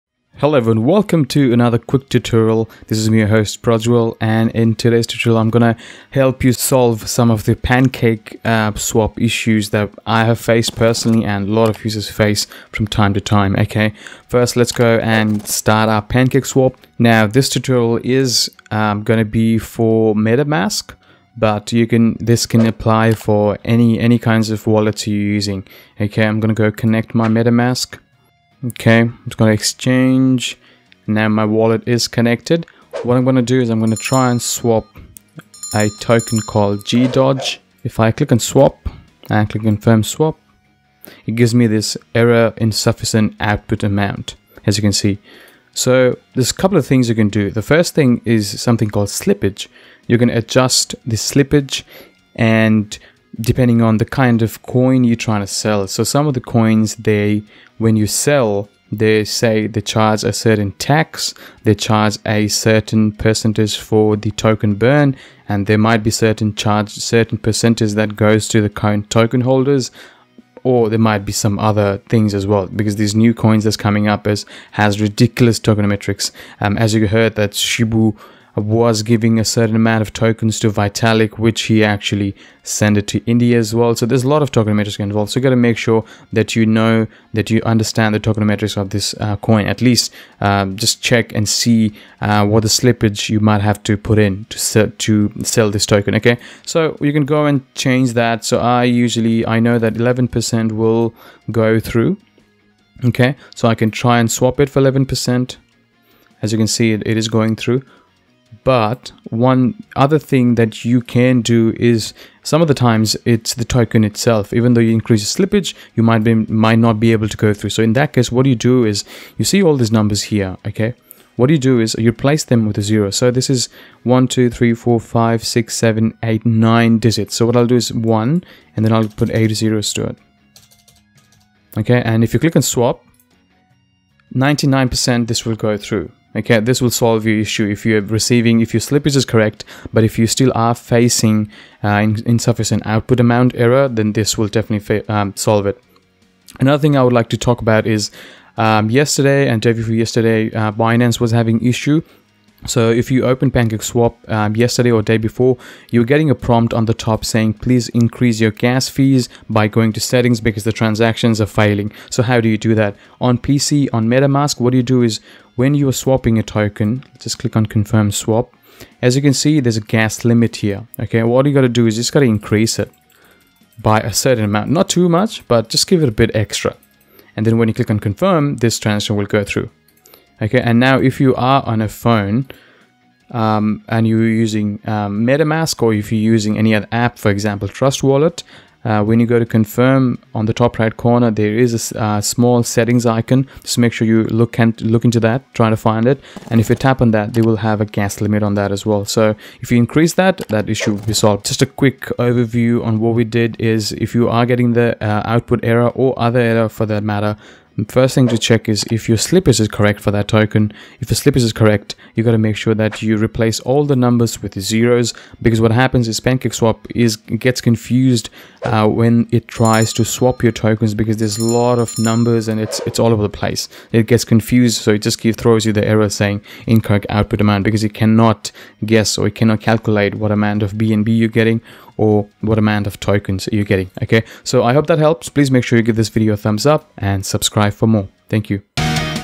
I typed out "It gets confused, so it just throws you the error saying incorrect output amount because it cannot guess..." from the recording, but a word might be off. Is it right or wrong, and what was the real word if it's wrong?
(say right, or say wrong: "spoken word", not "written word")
right.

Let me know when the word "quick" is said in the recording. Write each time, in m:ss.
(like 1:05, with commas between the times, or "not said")
0:01, 3:21.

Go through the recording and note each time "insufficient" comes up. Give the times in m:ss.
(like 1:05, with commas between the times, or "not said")
0:42, 2:22.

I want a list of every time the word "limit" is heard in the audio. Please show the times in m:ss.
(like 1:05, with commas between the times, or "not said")
2:50, 3:18.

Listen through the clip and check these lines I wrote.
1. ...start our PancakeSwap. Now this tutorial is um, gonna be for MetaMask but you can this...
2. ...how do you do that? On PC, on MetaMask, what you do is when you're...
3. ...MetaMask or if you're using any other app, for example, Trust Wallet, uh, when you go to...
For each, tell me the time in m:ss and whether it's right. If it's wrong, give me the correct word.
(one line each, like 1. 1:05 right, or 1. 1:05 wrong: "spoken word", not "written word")
1. 0:15 right
2. 2:42 right
3. 3:05 right.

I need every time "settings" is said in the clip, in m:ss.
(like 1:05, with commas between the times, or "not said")
2:39, 3:12.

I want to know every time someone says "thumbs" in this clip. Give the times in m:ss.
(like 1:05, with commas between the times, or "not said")
3:56.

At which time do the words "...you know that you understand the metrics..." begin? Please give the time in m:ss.
1:26.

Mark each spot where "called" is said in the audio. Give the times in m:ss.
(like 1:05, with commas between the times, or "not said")
0:36, 0:48.